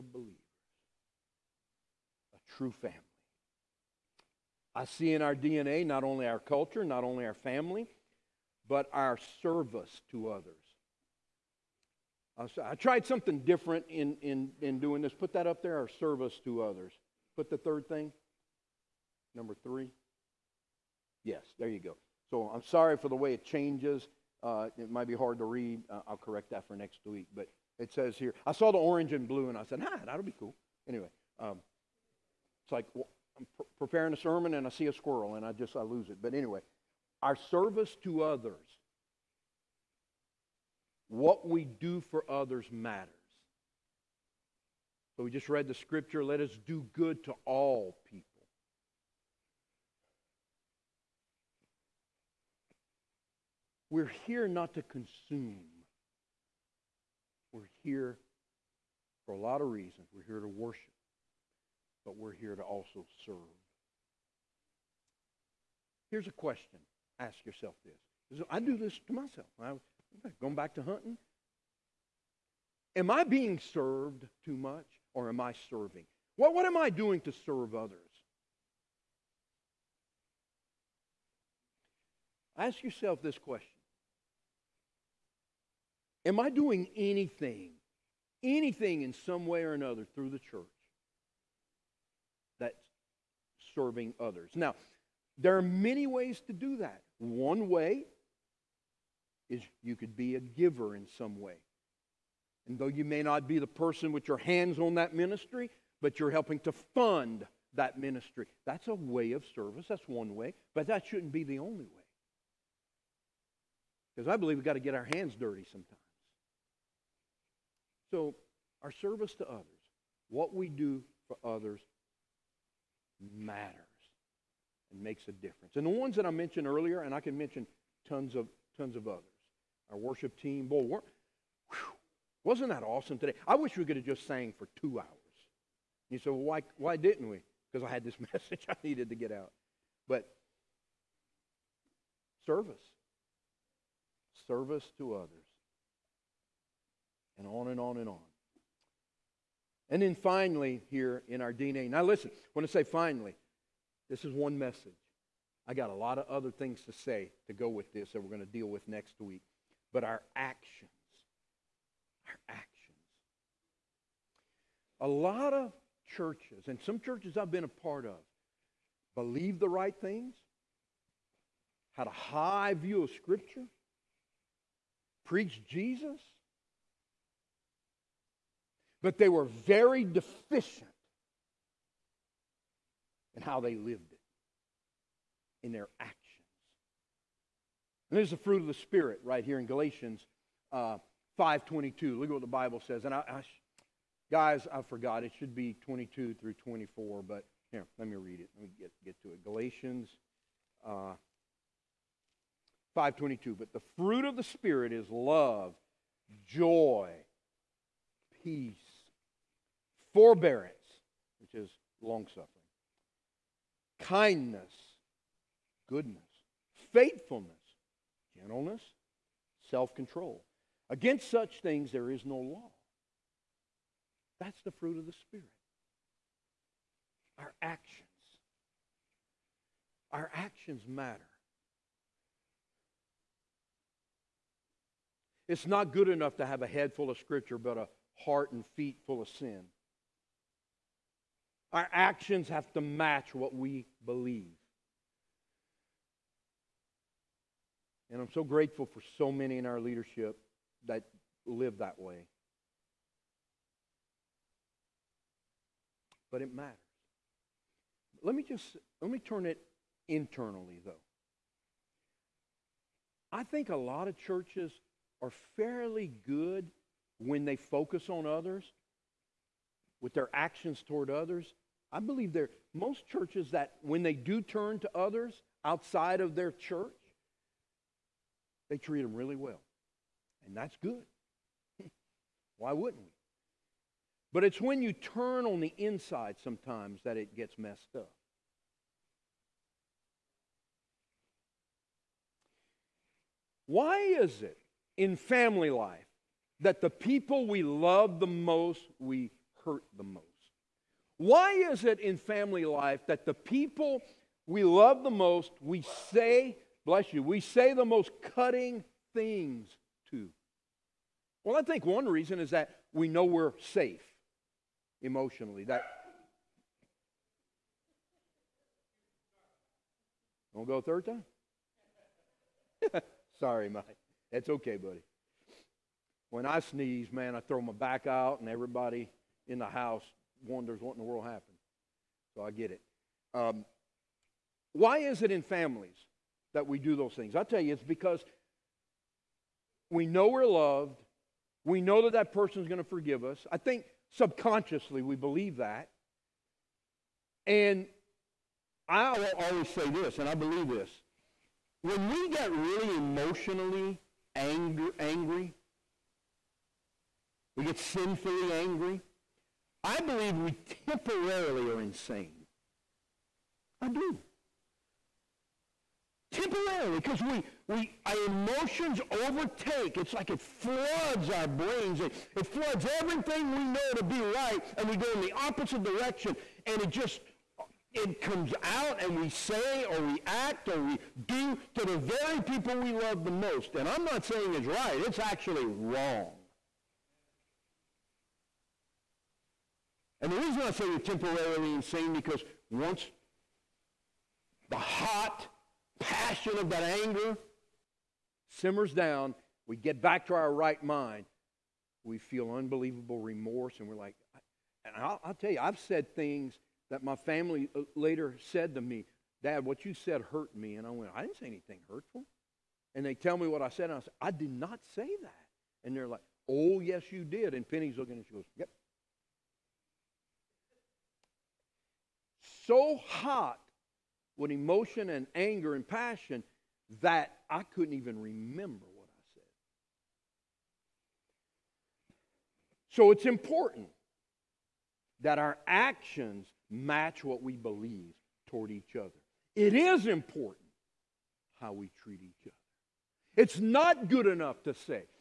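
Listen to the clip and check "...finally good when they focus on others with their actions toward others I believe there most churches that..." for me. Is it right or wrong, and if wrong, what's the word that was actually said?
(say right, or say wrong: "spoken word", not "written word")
wrong: "fairly", not "finally".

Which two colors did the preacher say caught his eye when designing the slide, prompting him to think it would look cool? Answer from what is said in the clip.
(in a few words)
orange and blue.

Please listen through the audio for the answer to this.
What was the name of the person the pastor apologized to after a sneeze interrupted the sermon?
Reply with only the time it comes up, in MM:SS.
05:23.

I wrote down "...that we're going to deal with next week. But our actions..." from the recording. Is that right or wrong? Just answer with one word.
right.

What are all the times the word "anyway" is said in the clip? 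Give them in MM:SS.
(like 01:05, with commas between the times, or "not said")
00:30, 00:36.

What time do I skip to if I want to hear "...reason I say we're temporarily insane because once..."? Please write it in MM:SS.
06:30.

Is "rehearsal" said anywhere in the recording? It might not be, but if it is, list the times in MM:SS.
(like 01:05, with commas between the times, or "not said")
not said.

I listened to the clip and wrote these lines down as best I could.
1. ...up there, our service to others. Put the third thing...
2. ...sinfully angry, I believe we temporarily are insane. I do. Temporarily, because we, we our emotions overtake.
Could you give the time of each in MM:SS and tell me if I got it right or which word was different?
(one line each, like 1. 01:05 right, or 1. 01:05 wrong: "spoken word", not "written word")
1. 00:15 right
2. 05:57 right.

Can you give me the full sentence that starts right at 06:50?
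And I went, I didn't say anything hurtful.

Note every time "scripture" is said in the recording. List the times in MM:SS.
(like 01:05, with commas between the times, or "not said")
00:45, 02:53, 03:57.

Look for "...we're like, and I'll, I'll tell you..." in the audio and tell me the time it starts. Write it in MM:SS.
06:43.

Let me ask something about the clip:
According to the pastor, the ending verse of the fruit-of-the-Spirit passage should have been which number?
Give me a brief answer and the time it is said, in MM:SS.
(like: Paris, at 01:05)
24, at 03:16.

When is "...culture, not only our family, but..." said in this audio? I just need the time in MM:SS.
00:06.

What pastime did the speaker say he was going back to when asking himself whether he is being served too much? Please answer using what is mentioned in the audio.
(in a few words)
hunting.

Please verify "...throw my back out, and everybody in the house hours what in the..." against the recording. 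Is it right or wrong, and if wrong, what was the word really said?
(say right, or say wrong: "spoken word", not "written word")
wrong: "wonders", not "hours".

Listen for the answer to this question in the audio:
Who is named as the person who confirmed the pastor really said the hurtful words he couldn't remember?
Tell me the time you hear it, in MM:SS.
06:57.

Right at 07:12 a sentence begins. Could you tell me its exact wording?
So it's important that our actions match what we believe toward each other.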